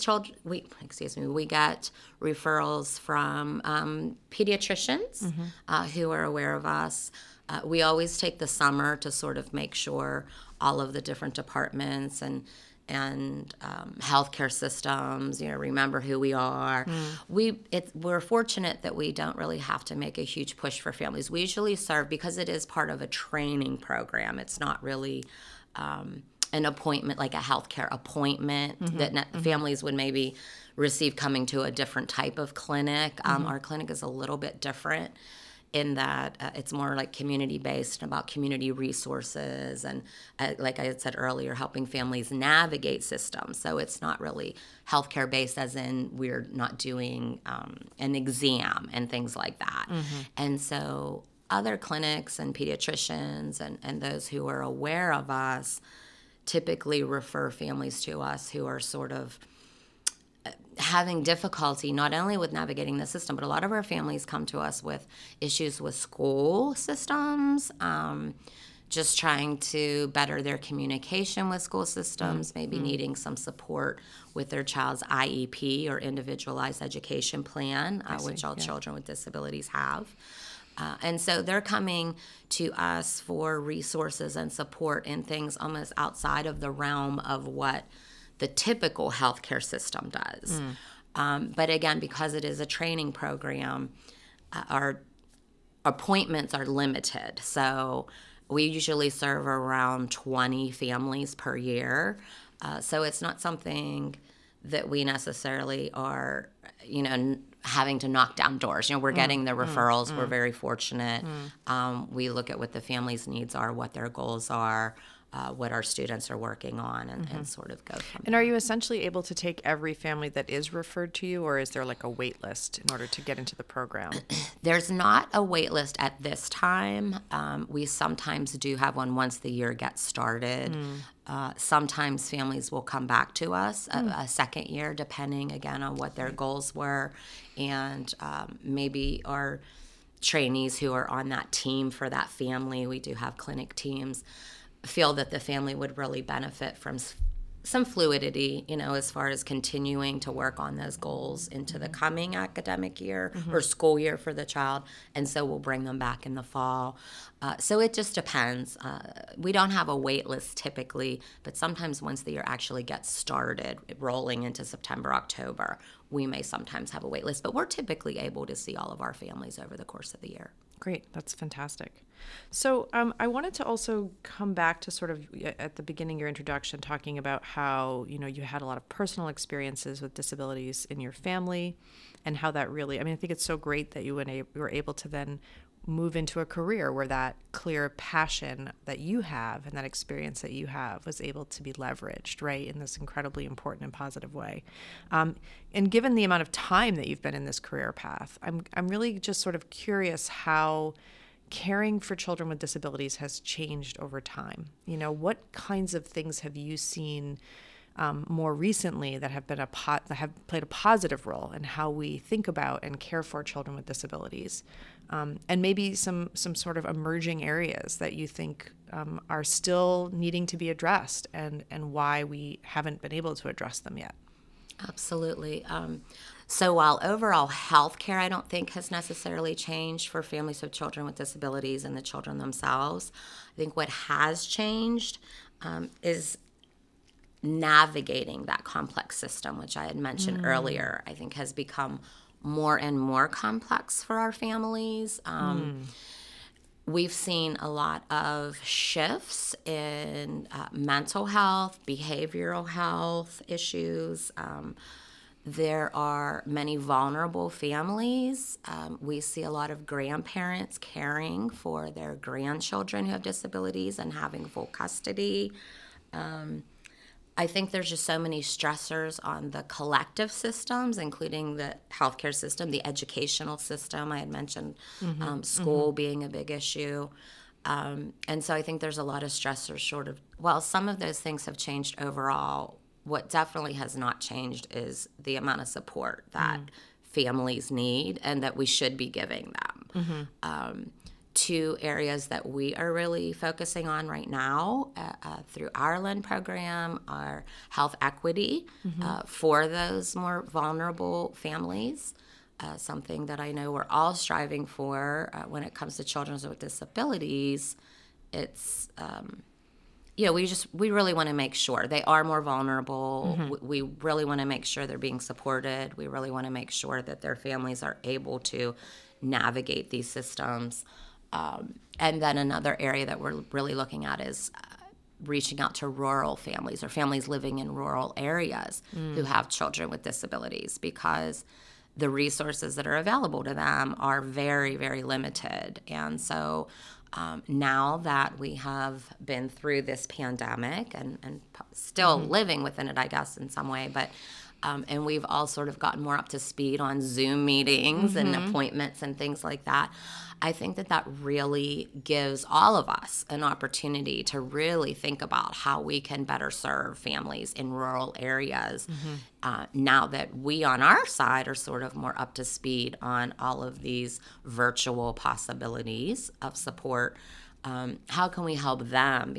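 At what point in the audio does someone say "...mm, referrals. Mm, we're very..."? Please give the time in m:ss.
1:49.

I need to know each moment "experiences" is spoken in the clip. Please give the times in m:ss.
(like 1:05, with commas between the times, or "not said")
2:59, 3:09.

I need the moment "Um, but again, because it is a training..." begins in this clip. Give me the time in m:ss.
1:31.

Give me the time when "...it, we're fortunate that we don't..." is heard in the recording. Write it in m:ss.
0:17.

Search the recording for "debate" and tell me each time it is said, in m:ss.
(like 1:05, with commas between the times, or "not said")
not said.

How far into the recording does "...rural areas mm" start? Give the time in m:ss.
5:27.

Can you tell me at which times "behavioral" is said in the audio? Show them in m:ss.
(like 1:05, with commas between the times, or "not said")
4:11.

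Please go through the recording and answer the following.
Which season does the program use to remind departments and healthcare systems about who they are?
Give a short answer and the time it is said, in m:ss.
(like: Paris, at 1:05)
Summer, at 0:08.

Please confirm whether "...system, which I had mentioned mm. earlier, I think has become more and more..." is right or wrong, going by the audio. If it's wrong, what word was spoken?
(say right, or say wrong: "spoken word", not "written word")
right.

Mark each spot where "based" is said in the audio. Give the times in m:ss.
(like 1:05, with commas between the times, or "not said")
0:37, 0:45.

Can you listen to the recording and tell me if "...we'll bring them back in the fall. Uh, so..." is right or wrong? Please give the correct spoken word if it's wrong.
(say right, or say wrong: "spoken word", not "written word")
right.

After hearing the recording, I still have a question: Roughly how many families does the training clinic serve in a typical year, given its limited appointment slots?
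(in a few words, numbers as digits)
20.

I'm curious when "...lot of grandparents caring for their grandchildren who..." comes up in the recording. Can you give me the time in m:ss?
4:19.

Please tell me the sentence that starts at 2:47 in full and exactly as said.
But we're typically able to see all of our families over the course of the year.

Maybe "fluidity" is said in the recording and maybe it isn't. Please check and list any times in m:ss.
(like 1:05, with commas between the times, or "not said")
2:27.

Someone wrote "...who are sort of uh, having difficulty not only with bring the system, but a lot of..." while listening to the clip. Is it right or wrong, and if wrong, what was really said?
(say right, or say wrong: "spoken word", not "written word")
wrong: "navigating", not "bring".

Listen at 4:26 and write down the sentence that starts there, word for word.
Um, I think there's just so many stressors on the collective systems, including the healthcare system, the educational system.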